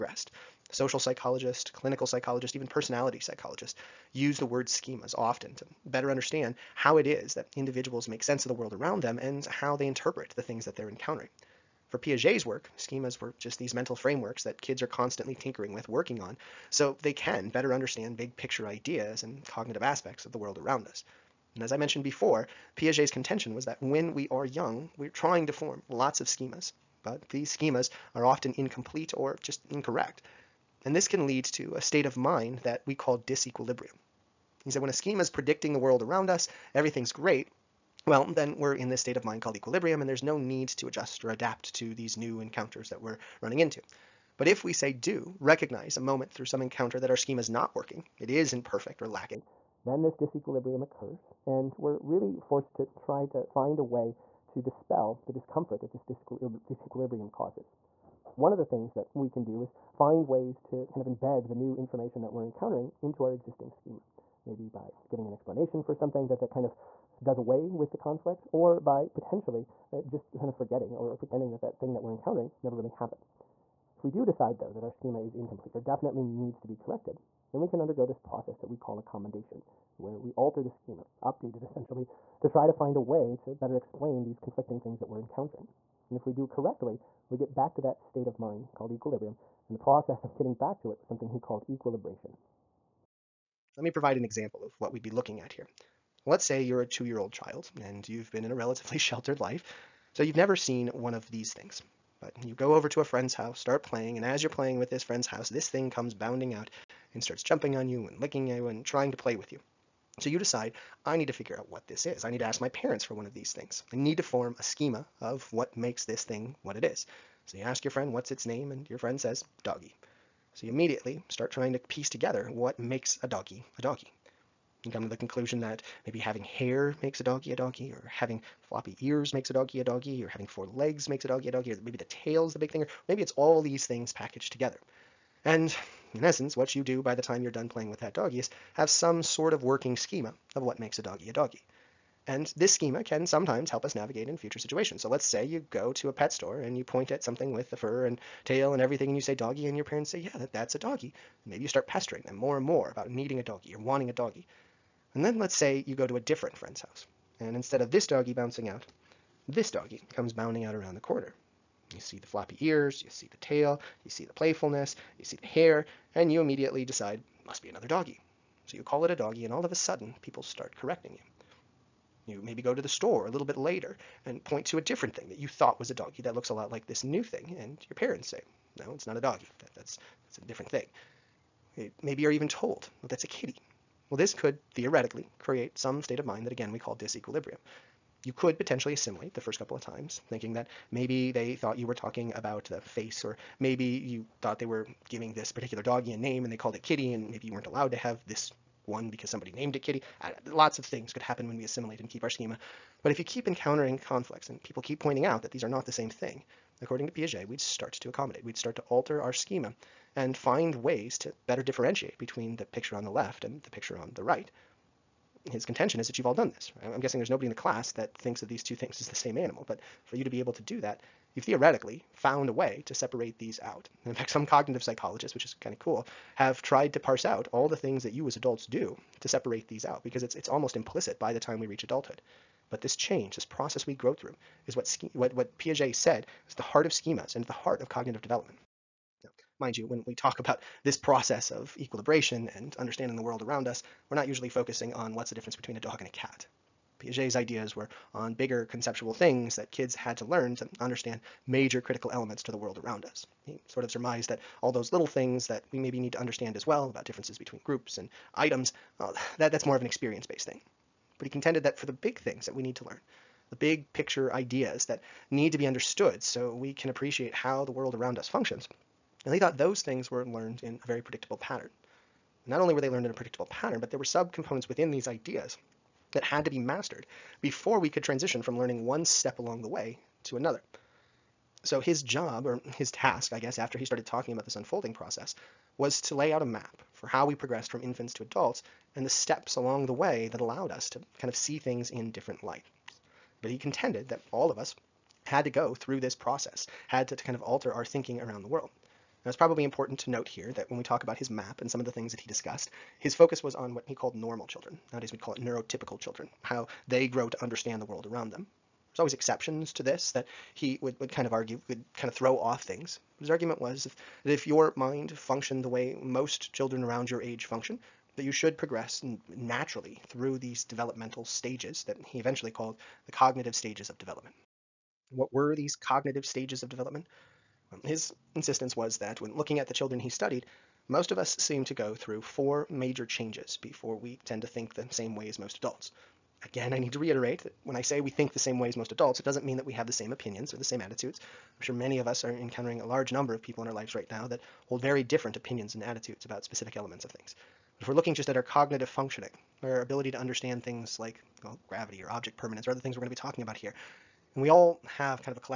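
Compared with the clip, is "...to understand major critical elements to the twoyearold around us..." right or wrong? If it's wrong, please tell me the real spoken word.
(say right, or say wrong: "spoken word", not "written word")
wrong: "world", not "twoyearold".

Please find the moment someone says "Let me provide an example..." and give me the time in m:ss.
1:33.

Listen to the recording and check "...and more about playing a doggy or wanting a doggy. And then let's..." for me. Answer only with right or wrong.
wrong.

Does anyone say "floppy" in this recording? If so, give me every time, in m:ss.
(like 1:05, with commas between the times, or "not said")
2:08, 2:42.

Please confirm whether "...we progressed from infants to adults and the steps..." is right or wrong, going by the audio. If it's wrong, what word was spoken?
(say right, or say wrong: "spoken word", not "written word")
right.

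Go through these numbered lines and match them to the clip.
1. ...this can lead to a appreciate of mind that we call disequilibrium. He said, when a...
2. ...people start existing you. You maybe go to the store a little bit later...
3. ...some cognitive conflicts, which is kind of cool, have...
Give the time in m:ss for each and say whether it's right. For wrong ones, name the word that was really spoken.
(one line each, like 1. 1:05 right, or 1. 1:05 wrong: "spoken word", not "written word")
1. 0:30 wrong: "state", not "appreciate"
2. 2:50 wrong: "correcting", not "existing"
3. 3:44 wrong: "psychologists", not "conflicts".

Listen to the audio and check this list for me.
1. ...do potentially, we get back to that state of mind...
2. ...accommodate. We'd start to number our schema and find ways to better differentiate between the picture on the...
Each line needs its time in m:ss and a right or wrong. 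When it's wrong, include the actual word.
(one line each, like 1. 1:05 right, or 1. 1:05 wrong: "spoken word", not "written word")
1. 1:26 wrong: "correctly", not "potentially"
2. 3:28 wrong: "alter", not "number".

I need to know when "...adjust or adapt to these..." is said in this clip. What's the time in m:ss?
0:40.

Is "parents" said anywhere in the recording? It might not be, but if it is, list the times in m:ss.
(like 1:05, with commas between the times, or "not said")
1:52, 2:29, 2:57.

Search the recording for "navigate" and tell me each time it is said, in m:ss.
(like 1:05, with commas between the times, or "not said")
2:23.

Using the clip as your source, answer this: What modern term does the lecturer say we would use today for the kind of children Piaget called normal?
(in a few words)
neurotypical.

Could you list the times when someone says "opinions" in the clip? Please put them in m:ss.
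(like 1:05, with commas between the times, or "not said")
5:40, 5:45.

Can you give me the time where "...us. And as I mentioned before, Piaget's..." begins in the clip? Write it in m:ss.
0:20.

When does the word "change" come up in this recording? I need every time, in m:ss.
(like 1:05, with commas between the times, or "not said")
3:52, 5:33.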